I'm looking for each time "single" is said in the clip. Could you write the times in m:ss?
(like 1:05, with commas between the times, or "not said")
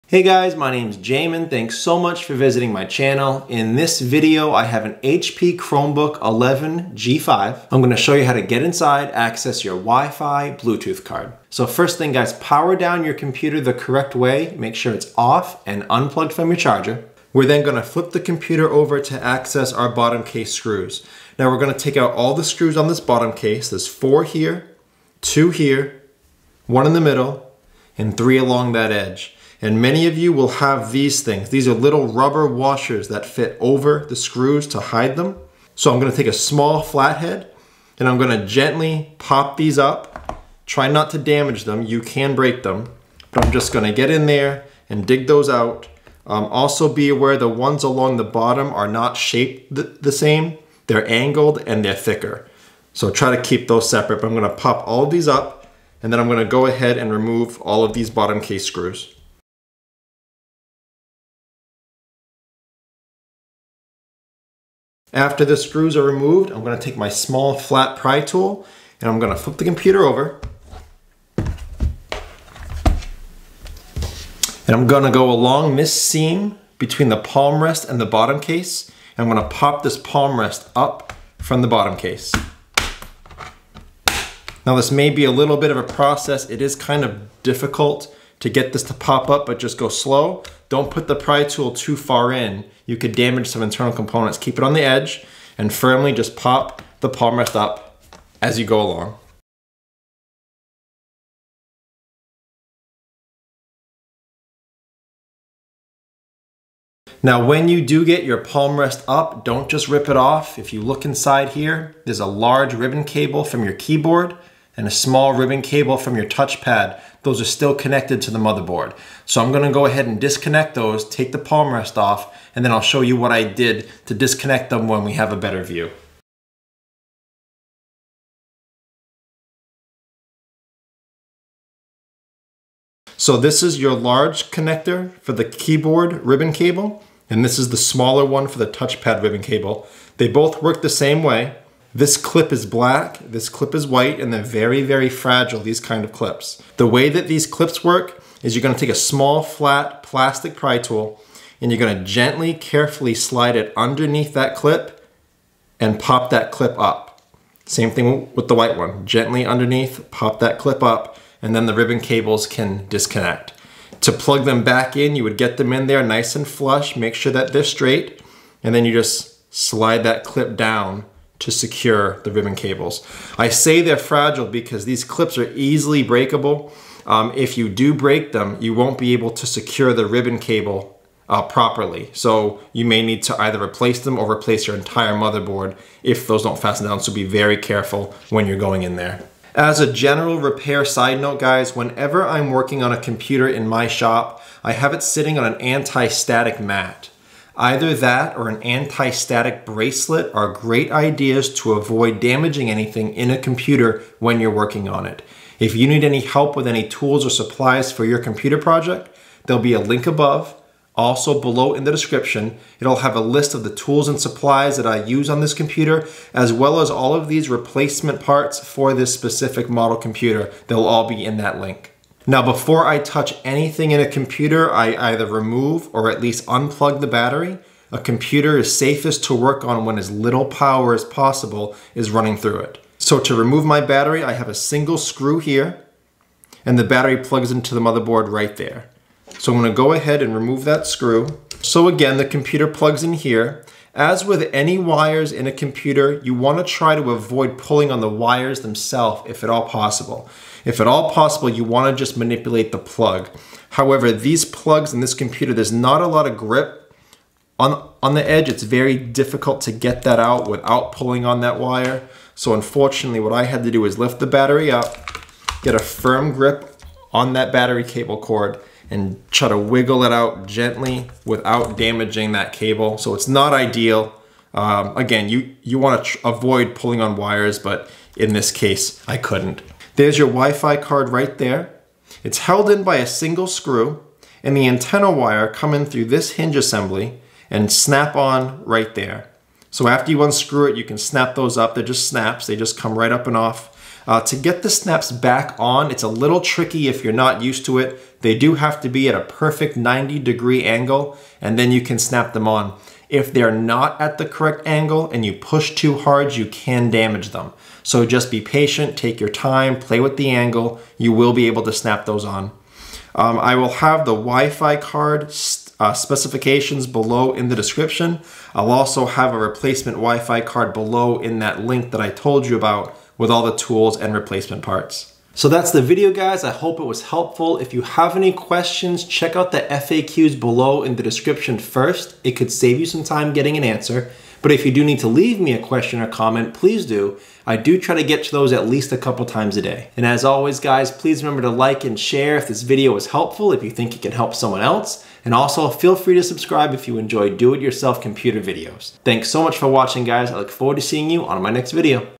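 3:54, 4:43.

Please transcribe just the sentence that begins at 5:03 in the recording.
If they're not at the correct angle and you push too hard, you can damage them.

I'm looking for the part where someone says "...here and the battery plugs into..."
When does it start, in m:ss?
3:55.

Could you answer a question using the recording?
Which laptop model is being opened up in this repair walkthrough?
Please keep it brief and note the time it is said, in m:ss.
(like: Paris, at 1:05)
HP Chromebook 11 G5, at 0:04.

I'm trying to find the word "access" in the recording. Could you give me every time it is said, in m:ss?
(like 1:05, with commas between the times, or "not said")
0:09, 0:19.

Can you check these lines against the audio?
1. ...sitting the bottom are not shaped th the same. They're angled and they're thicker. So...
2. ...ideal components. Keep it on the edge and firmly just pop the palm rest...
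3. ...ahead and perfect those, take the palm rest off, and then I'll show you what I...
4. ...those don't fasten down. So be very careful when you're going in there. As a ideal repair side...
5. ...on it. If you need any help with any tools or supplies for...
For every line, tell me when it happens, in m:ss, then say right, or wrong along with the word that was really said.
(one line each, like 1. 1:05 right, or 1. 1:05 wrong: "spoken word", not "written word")
1. 0:47 wrong: "along", not "sitting"
2. 1:33 wrong: "internal", not "ideal"
3. 1:59 wrong: "disconnect", not "perfect"
4. 3:06 wrong: "general", not "ideal"
5. 3:24 right.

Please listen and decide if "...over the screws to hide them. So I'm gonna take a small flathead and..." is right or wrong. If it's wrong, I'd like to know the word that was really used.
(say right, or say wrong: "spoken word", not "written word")
right.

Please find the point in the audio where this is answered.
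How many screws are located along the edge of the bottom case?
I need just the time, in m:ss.
0:28.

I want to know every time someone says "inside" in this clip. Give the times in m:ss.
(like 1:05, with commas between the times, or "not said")
0:08, 1:51.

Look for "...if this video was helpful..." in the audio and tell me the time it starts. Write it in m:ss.
5:42.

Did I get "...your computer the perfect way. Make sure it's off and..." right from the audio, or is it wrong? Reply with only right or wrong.
wrong.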